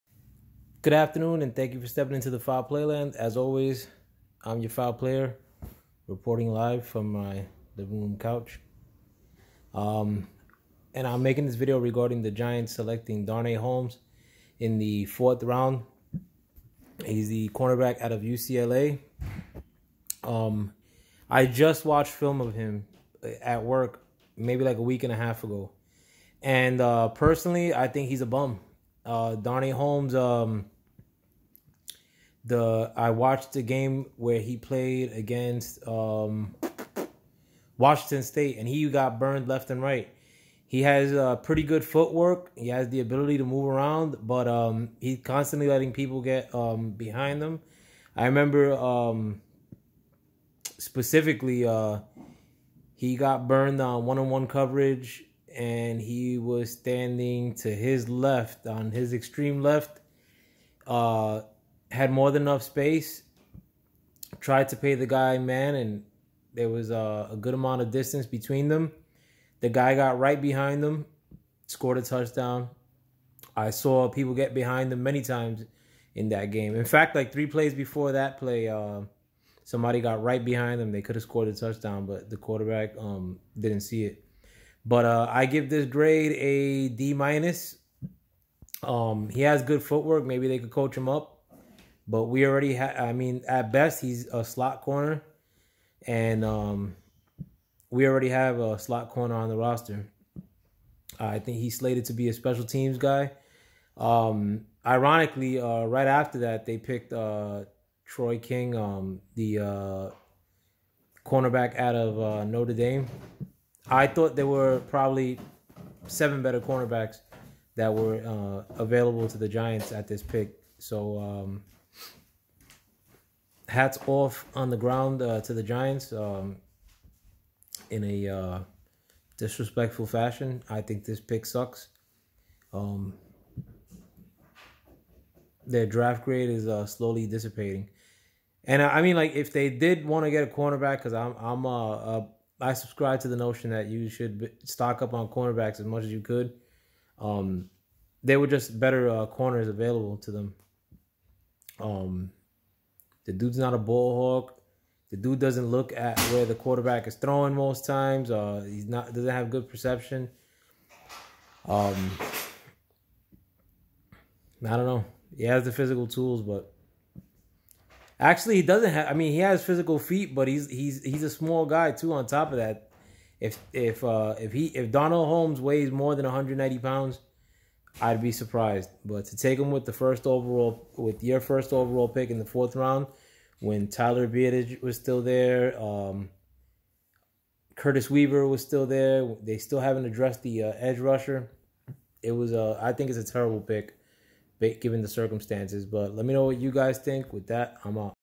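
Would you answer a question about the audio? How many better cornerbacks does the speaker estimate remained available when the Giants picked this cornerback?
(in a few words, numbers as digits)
7.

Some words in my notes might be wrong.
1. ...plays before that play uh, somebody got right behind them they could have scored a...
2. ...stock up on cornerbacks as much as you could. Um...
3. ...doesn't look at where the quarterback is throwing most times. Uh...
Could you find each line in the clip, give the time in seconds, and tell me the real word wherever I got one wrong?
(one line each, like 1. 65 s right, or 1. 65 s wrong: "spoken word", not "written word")
1. 77 s right
2. 144 s right
3. 155 s right.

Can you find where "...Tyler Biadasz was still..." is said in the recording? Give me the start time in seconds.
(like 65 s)
183 s.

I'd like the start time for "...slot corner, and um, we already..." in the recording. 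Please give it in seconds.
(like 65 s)
94 s.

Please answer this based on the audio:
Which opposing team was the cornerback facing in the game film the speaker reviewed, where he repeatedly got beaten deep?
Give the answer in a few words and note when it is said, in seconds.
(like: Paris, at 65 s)
Washington State, at 37 s.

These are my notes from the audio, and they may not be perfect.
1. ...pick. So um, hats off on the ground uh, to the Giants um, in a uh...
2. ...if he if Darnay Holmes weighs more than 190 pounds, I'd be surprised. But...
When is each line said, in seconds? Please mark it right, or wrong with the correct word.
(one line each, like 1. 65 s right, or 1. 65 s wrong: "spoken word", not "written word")
1. 120 s right
2. 174 s right.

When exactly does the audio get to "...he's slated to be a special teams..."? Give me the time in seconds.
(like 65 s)
101 s.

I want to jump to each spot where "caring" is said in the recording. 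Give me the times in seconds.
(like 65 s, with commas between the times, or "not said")
not said.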